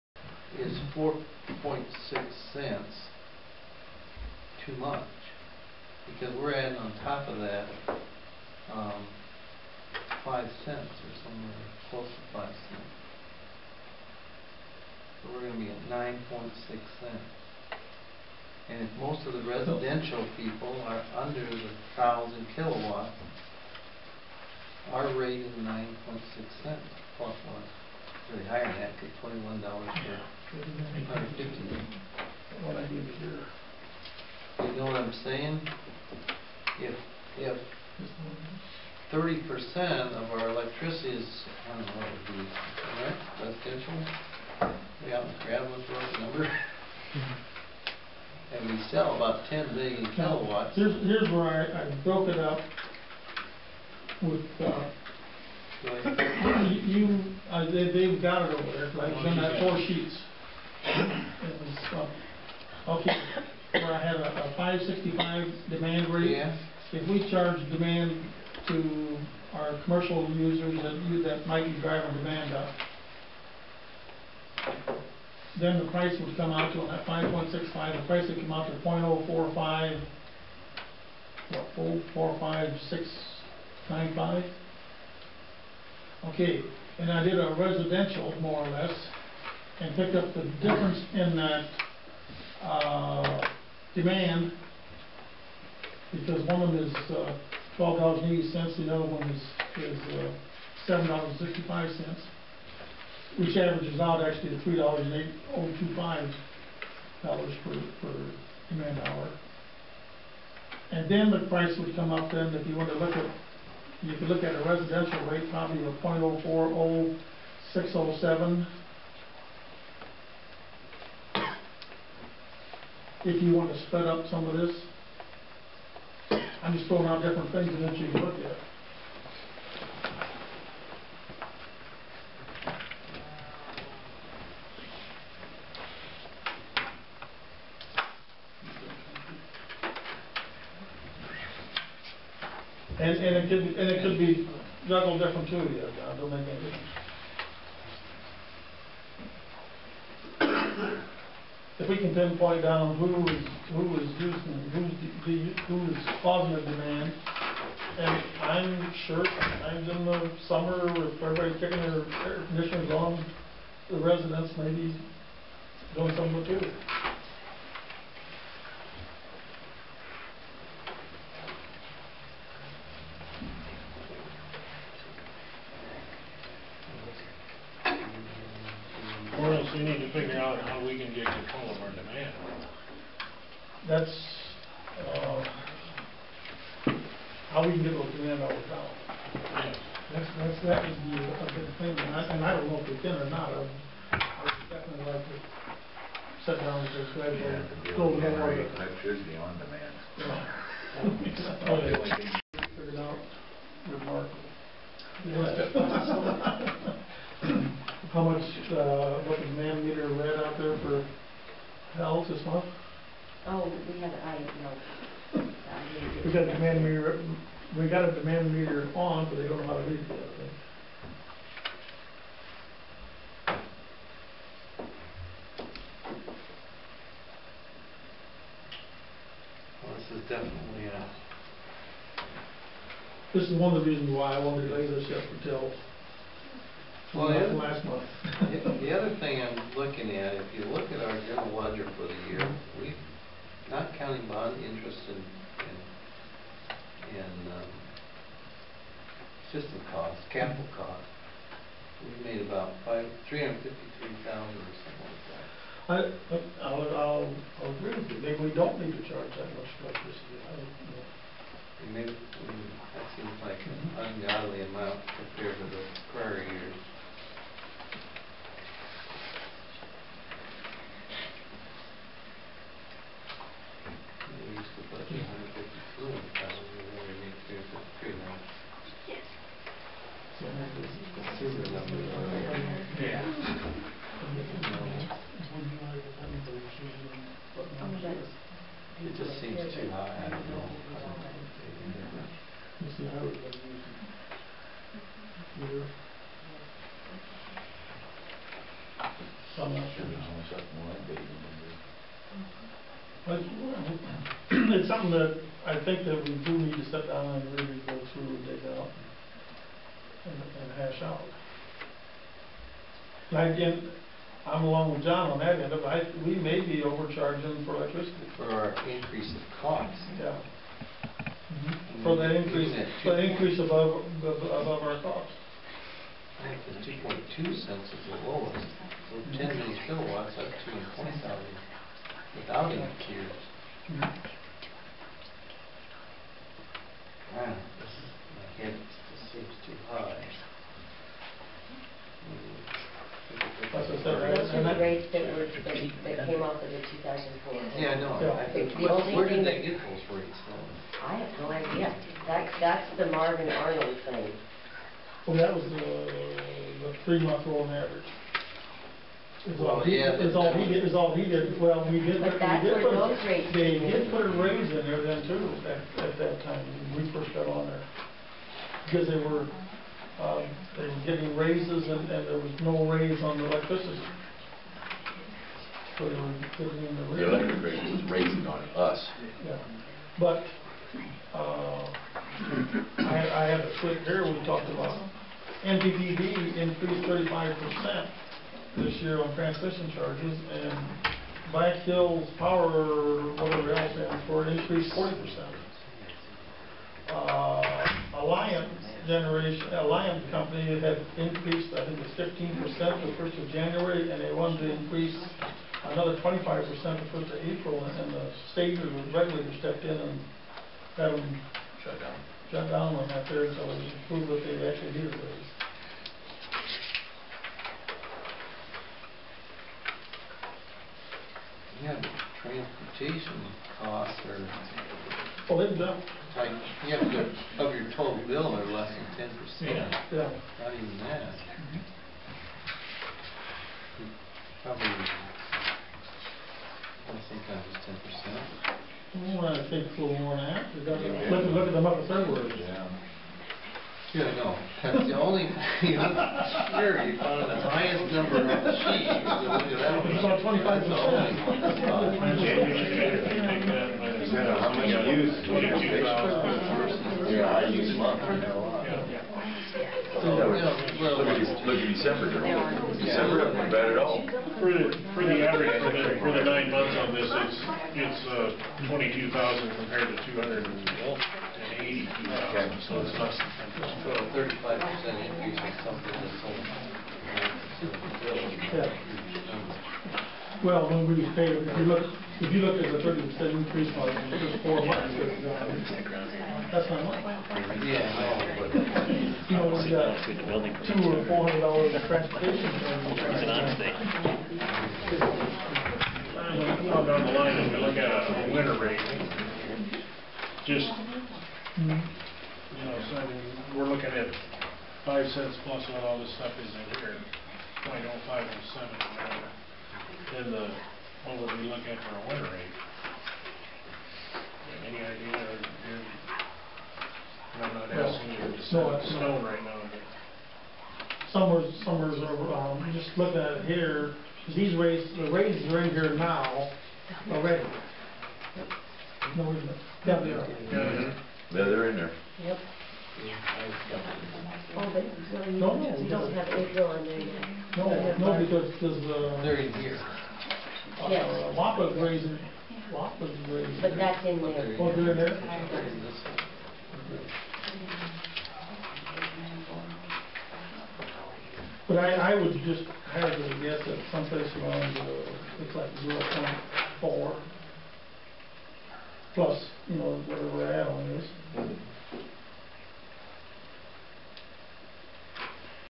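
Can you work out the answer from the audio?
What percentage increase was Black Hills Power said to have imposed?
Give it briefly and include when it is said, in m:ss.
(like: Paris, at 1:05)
40%, at 6:34.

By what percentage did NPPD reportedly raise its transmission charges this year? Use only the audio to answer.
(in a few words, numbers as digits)
35%.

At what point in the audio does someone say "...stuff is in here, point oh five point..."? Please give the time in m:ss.
8:26.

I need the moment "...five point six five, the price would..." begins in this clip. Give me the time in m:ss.
1:17.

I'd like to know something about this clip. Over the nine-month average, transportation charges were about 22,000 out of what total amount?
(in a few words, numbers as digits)
280,000.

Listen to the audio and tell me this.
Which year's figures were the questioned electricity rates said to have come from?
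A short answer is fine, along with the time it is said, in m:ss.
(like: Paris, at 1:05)
2004, at 5:46.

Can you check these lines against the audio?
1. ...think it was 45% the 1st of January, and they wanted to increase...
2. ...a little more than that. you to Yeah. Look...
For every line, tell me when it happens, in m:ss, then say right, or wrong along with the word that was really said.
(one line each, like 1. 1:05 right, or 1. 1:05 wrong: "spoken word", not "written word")
1. 6:41 wrong: "15", not "45"
2. 7:19 right.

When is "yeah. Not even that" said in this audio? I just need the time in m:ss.
7:10.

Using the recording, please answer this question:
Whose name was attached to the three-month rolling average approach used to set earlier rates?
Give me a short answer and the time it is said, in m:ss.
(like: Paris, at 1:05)
Marvin Arnold, at 5:53.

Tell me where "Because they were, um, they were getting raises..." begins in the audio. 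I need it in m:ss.
6:08.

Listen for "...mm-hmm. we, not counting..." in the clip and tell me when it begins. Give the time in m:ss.
4:02.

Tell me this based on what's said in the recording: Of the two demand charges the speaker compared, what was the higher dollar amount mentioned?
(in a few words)
$12.80.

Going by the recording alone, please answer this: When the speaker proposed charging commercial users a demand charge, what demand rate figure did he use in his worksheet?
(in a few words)
5.65.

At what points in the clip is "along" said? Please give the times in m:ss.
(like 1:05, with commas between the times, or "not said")
5:14.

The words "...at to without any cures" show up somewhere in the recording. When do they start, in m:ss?
5:30.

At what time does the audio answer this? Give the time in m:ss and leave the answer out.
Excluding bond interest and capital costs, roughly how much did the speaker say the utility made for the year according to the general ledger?
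4:13.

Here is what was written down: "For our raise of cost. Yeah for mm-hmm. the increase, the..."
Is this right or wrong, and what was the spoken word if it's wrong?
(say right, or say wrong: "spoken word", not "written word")
wrong: "increase", not "raise".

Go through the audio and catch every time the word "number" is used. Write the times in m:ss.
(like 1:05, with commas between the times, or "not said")
0:46, 7:28.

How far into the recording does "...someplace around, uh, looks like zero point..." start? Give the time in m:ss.
9:14.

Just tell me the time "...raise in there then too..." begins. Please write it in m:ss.
6:04.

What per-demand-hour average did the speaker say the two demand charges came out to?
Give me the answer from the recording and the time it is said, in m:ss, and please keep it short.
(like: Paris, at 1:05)
$3.8025, at 1:44.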